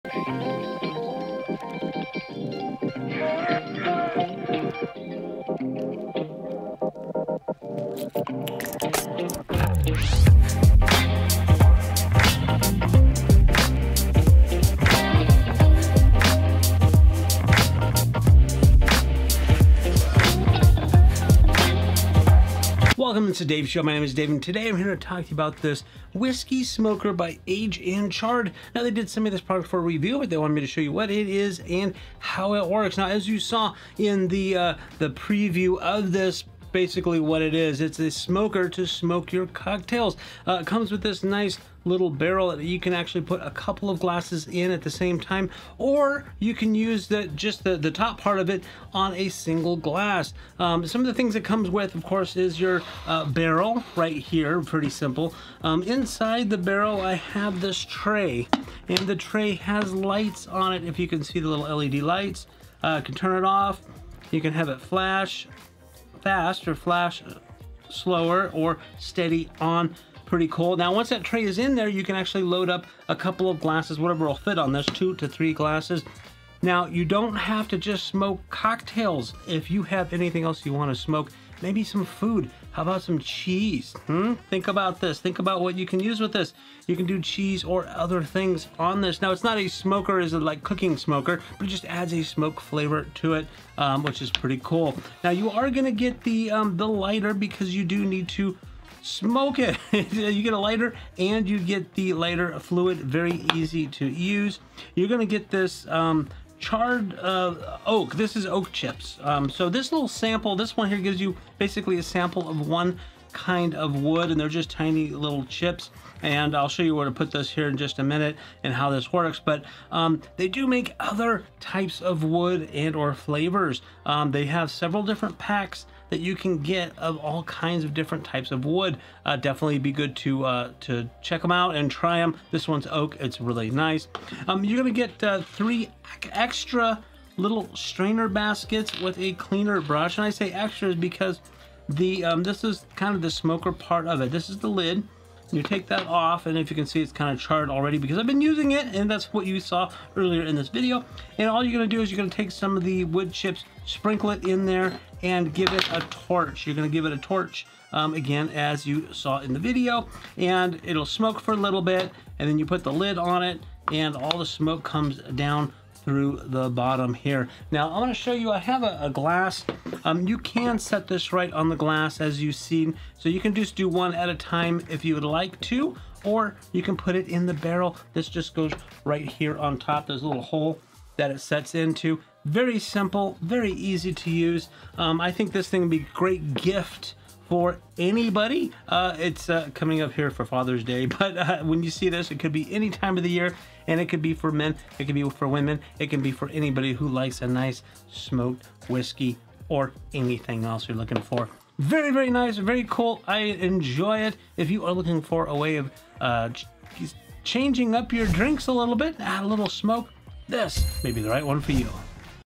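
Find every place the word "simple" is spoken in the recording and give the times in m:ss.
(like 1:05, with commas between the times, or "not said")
0:54, 3:02.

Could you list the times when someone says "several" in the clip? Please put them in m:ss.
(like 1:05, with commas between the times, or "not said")
2:04.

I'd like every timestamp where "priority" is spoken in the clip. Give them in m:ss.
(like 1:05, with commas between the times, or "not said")
not said.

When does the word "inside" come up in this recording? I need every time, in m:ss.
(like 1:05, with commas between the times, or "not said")
0:55.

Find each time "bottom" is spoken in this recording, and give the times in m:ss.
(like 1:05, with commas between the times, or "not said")
2:46.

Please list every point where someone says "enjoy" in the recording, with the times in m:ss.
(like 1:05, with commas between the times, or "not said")
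3:23.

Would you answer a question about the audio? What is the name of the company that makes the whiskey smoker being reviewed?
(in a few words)
Aged and Charred.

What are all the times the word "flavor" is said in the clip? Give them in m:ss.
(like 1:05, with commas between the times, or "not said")
1:32, 2:03.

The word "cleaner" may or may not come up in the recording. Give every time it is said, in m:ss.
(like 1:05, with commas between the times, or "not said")
2:19.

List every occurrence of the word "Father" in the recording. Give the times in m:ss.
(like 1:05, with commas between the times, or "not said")
3:10.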